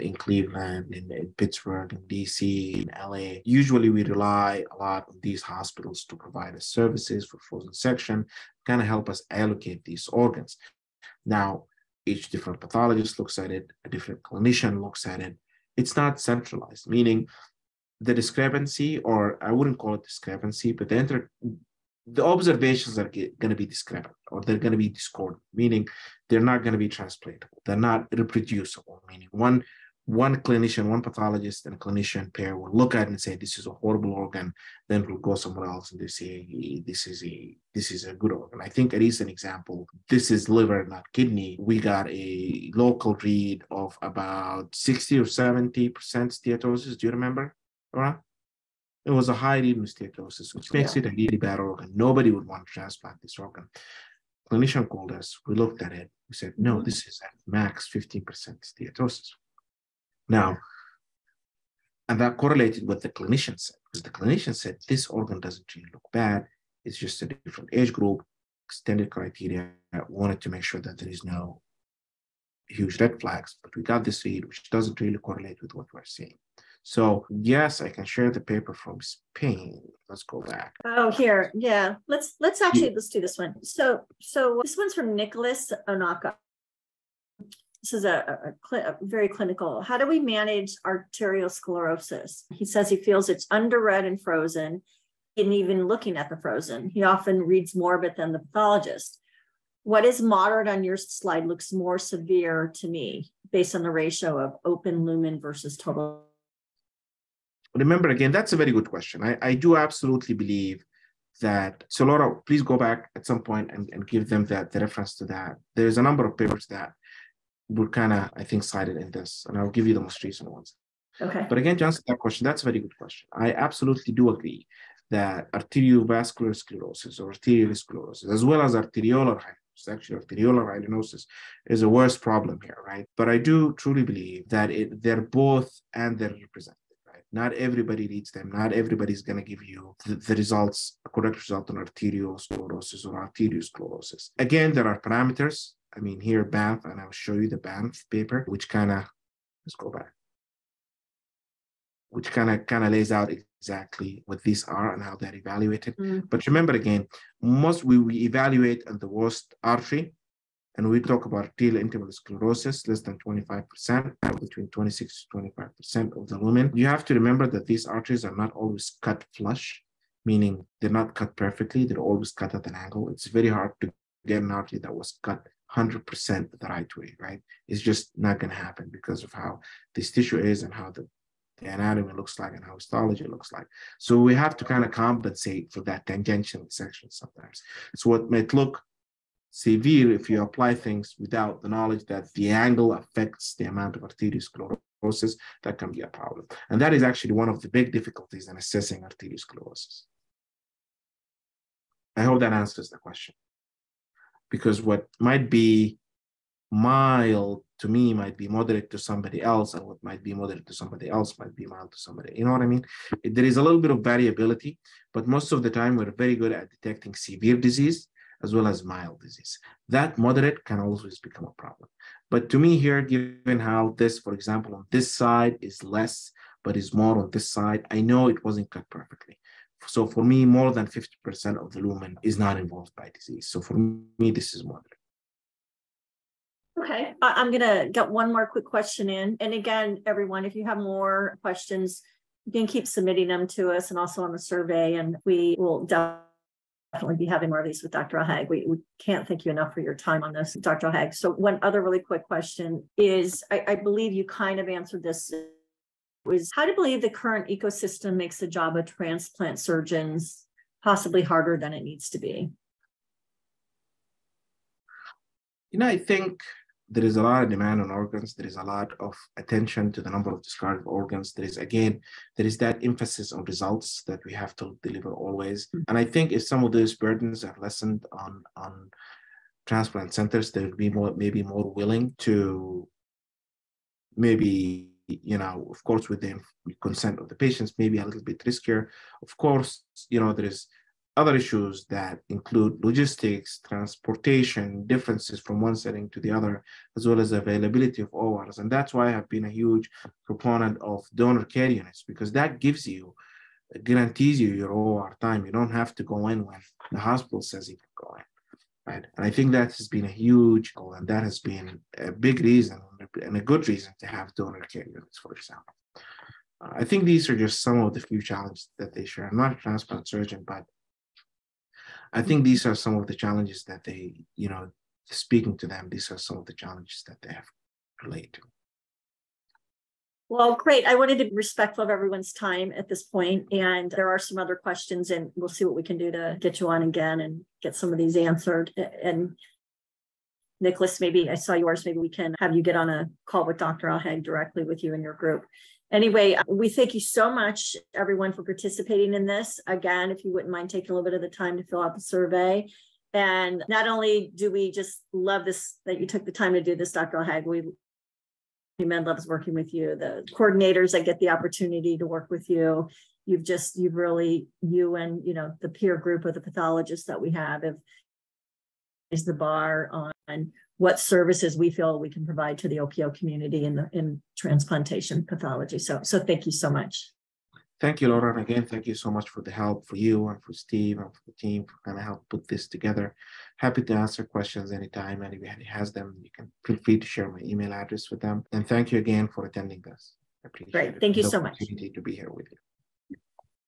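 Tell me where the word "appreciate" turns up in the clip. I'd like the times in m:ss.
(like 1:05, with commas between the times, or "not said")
6:30.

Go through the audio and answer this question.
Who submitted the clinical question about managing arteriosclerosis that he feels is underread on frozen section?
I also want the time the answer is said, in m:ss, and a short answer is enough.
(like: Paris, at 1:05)
Nicholas Onaka, at 1:25.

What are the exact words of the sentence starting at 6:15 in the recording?
So, so thank you so much.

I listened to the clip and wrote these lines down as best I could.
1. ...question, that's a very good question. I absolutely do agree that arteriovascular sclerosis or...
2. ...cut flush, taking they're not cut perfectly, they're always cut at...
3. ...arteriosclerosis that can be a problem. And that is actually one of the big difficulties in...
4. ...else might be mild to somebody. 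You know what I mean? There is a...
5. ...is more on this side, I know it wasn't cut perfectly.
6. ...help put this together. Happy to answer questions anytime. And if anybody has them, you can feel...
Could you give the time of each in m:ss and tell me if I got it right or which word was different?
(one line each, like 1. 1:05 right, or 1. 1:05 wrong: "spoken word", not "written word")
1. 2:02 right
2. 2:49 wrong: "meaning", not "taking"
3. 3:14 right
4. 3:31 right
5. 3:46 right
6. 6:22 right.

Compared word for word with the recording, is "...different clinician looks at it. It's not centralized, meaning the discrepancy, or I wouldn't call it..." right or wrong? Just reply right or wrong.
right.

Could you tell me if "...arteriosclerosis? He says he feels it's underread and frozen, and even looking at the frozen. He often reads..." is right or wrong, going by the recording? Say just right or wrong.
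right.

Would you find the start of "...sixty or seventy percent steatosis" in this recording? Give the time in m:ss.
0:44.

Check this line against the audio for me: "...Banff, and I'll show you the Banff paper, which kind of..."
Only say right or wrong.
right.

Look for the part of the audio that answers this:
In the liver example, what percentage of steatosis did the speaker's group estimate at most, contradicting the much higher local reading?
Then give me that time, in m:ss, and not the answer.
0:57.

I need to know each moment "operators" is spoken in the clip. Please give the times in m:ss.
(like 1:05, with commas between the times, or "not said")
not said.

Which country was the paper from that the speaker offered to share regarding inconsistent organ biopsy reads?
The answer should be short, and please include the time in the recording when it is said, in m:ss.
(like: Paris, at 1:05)
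Spain, at 1:19.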